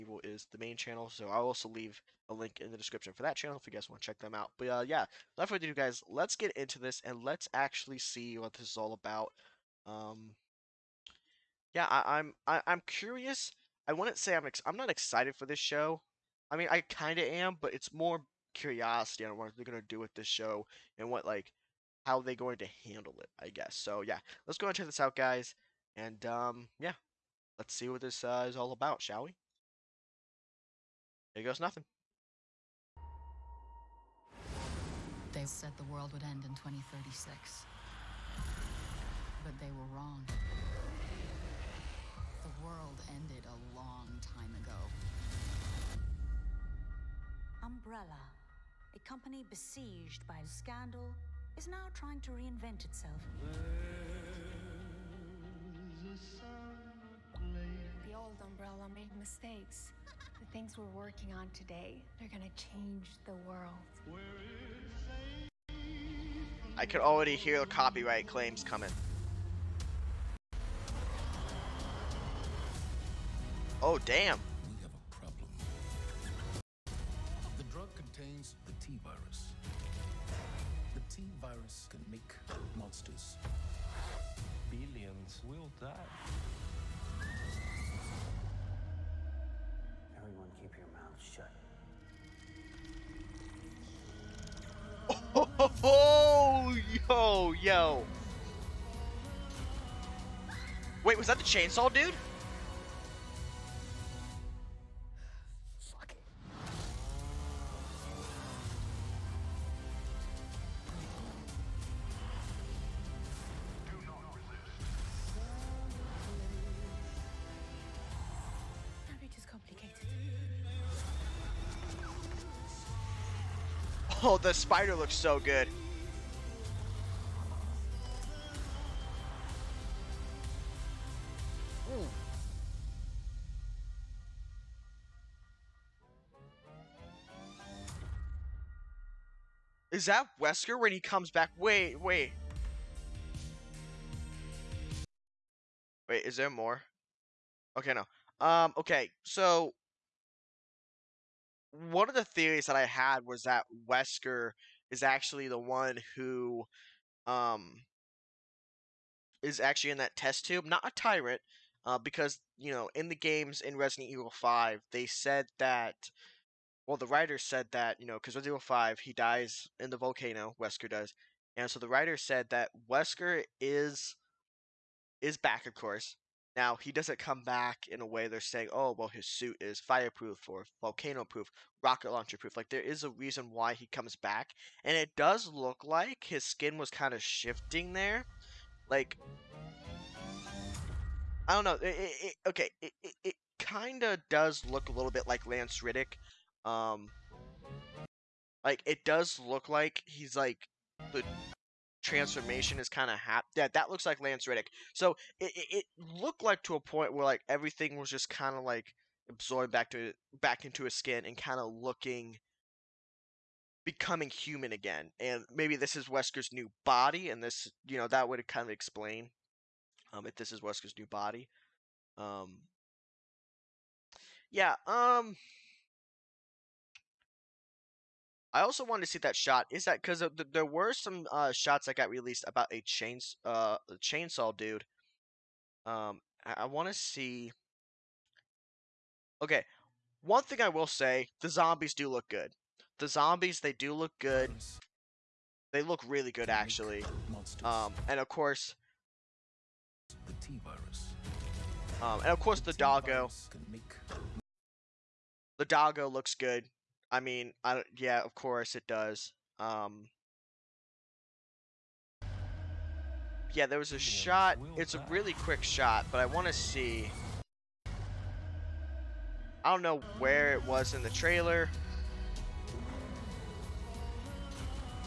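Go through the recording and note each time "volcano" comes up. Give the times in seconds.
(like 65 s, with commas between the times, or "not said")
169 s, 180 s.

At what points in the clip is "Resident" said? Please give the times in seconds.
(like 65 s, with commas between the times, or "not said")
163 s, 168 s.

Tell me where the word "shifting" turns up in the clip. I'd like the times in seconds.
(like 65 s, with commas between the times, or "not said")
187 s.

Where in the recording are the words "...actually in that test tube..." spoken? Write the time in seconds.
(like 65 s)
159 s.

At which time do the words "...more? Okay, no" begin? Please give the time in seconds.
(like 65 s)
146 s.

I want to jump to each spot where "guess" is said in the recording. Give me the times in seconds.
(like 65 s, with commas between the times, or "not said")
23 s.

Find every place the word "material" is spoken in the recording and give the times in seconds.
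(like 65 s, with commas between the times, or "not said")
not said.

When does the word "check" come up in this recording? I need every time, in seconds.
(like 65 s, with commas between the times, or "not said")
4 s, 24 s.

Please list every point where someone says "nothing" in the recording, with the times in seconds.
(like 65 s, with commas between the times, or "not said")
31 s.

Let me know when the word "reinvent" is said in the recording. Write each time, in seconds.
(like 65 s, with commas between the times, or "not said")
52 s.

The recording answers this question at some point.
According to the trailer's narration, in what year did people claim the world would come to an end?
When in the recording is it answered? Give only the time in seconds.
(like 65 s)
36 s.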